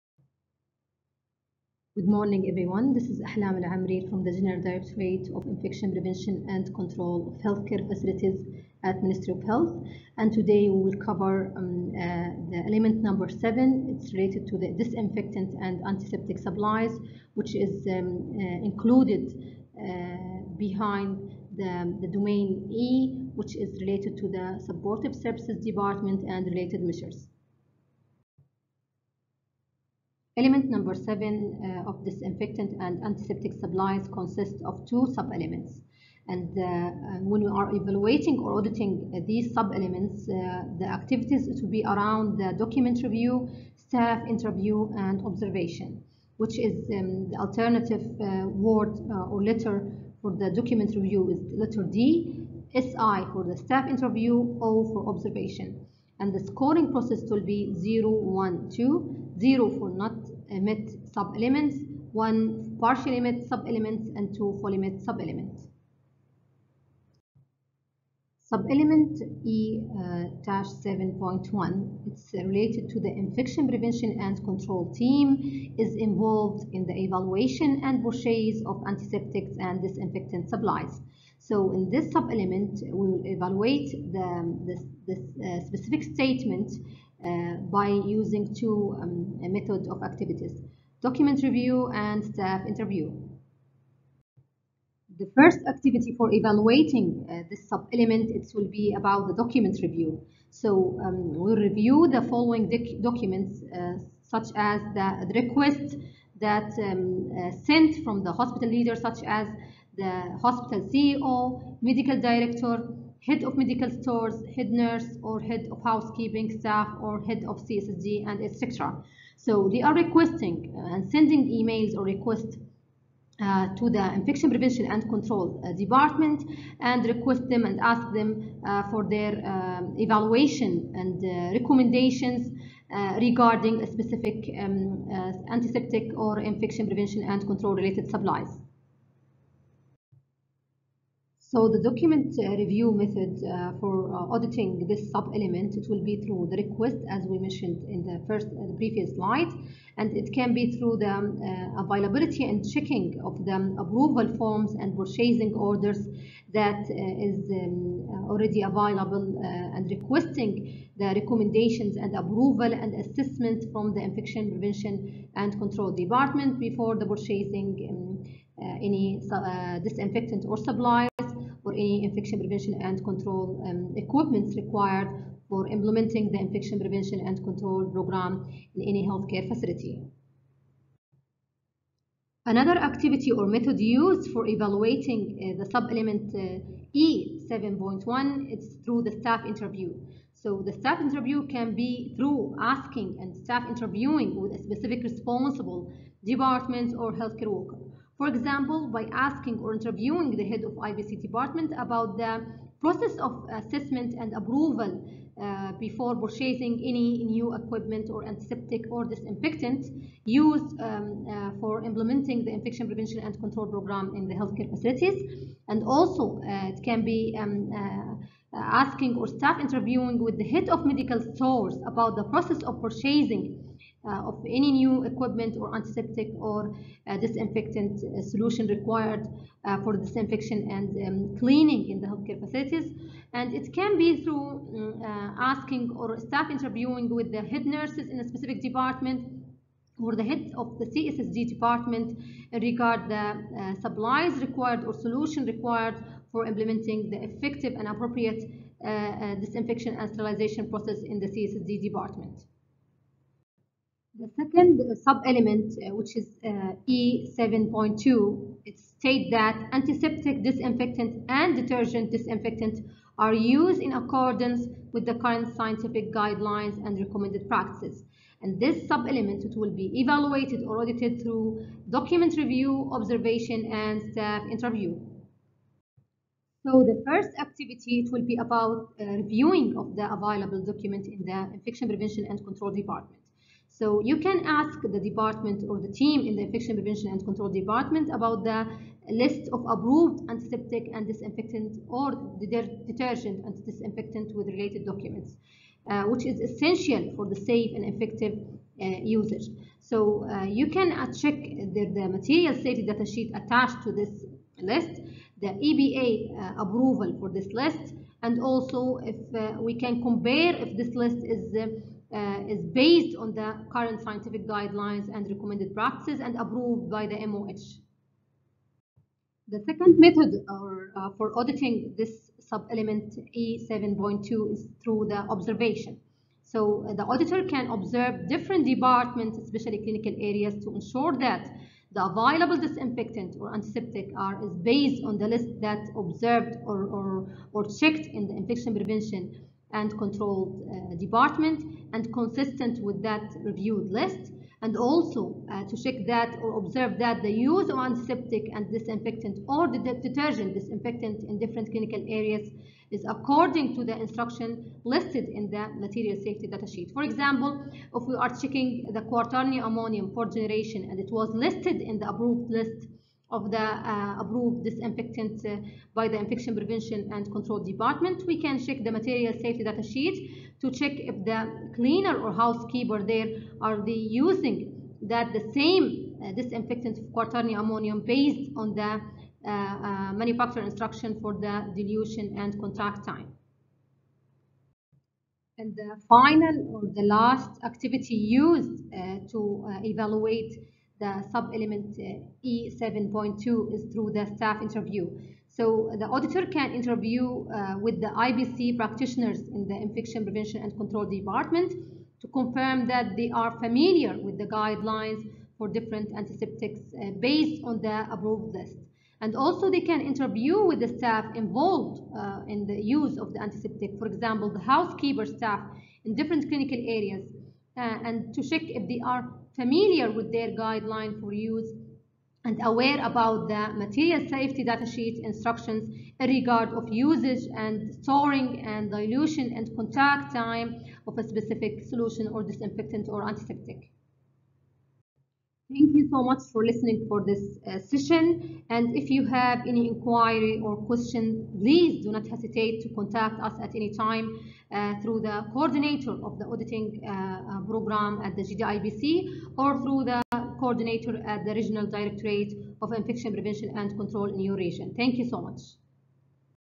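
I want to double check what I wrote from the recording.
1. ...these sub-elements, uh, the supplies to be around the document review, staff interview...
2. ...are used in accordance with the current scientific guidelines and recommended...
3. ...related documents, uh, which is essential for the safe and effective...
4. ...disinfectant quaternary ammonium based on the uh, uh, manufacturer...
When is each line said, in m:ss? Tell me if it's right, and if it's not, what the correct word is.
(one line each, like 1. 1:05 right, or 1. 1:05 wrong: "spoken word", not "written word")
1. 0:39 wrong: "activities", not "supplies"
2. 4:23 right
3. 4:54 right
4. 6:16 right.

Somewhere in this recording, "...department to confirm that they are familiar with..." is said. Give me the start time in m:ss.
6:41.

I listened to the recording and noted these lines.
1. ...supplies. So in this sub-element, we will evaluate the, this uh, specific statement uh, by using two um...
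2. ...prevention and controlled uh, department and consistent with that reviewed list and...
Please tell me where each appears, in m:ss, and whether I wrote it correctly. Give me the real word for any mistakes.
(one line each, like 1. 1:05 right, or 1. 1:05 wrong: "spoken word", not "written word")
1. 1:20 right
2. 5:38 right.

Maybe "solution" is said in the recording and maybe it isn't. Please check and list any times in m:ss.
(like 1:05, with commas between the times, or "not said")
3:48, 4:04, 7:11.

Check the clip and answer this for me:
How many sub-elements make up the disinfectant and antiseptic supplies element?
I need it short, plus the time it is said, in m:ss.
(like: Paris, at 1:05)
2, at 0:34.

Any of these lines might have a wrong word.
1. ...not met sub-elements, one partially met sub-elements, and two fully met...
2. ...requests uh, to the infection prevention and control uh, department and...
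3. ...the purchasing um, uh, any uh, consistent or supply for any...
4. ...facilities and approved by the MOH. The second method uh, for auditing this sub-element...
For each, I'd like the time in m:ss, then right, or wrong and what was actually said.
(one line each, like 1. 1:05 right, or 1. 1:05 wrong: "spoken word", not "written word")
1. 0:59 right
2. 2:02 right
3. 2:46 wrong: "disinfectant", not "consistent"
4. 5:15 wrong: "practices", not "facilities".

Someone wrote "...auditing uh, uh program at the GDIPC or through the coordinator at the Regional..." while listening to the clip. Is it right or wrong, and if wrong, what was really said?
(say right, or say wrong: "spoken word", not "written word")
right.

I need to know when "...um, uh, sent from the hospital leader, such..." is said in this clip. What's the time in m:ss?
1:46.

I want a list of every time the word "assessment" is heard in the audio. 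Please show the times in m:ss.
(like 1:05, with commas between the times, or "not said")
2:43, 3:23.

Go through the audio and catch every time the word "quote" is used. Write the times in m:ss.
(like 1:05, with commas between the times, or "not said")
not said.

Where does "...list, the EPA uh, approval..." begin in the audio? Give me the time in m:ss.
5:04.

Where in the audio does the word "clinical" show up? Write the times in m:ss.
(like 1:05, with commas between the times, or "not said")
5:29, 5:51, 6:56.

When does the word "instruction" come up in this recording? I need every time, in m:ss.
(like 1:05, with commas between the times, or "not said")
5:53, 6:20, 7:05.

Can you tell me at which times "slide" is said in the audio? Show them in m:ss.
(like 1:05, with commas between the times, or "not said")
2:29.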